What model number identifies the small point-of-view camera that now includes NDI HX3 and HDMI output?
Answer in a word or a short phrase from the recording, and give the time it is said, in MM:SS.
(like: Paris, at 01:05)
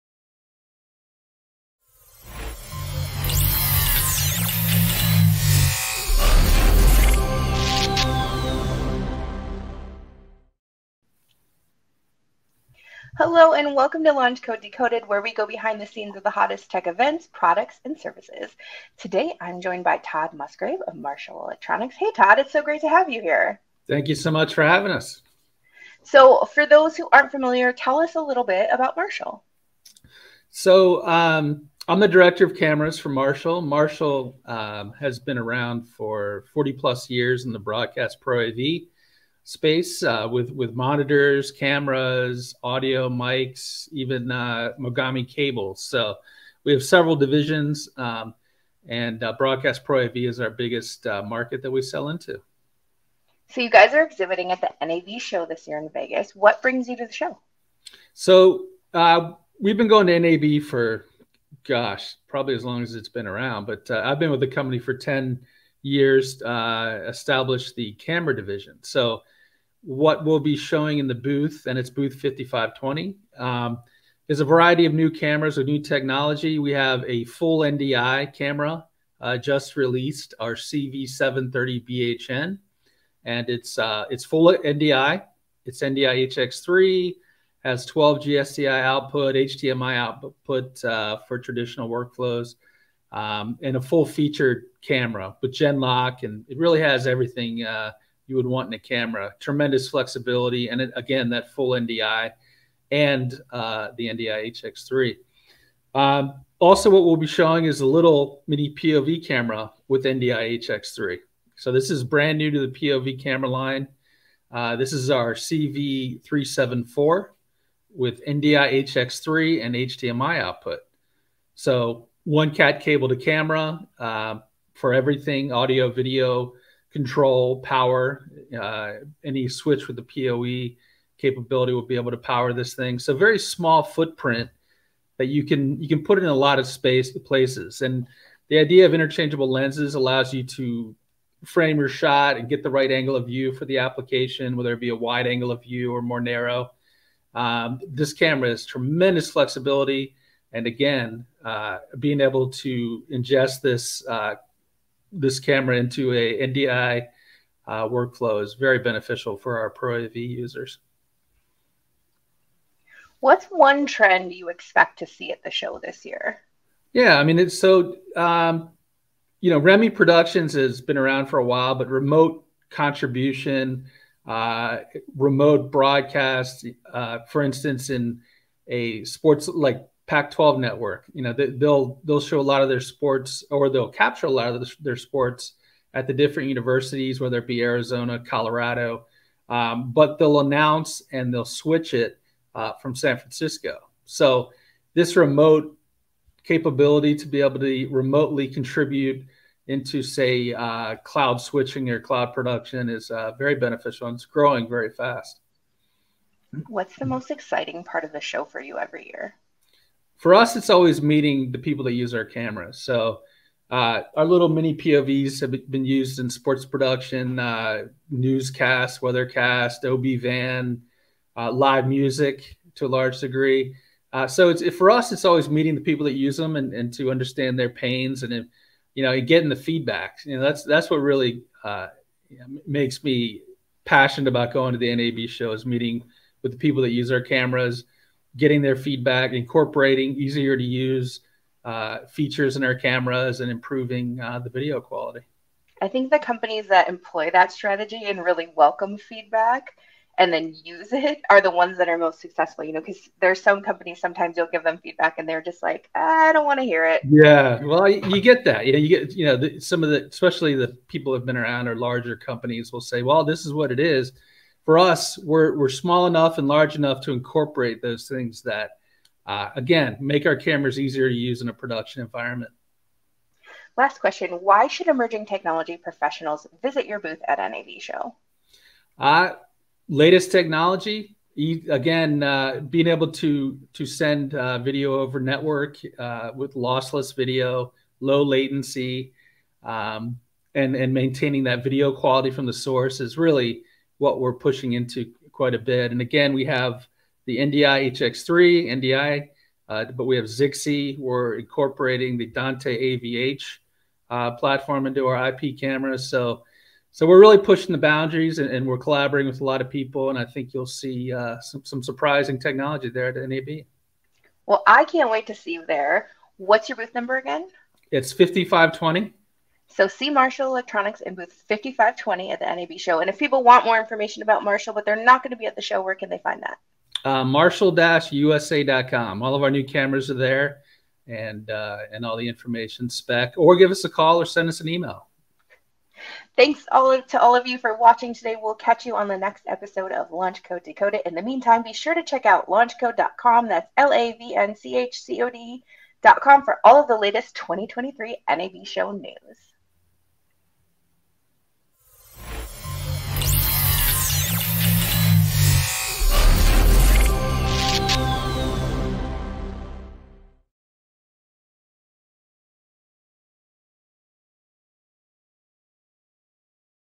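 CV374, at 01:55.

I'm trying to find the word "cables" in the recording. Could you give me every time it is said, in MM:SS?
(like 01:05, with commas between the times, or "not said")
00:45, 02:02.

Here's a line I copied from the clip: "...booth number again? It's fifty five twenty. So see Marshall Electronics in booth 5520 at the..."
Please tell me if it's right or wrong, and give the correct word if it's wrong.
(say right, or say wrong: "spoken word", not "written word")
right.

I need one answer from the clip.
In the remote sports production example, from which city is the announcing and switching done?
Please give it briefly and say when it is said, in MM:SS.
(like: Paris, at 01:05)
San Francisco, at 03:12.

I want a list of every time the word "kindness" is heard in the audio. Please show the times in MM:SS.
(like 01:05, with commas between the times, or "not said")
not said.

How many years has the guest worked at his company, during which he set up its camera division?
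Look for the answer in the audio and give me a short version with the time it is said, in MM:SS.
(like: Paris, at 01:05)
10 years, at 01:05.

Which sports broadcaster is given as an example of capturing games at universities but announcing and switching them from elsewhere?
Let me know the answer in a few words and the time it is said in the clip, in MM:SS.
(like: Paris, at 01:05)
Pac-12 network, at 03:00.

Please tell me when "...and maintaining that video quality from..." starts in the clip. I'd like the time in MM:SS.
04:50.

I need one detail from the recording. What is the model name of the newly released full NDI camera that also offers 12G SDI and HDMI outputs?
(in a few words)
CV730BHN.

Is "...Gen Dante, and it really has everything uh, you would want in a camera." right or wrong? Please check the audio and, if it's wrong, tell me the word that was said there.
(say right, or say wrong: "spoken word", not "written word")
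wrong: "Lock", not "Dante".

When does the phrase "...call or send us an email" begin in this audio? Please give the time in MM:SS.
05:33.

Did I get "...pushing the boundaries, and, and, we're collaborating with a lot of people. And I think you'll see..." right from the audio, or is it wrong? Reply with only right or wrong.
right.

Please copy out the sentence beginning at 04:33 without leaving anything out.
Last question Why should emerging technology professionals visit your booth at NAB Show?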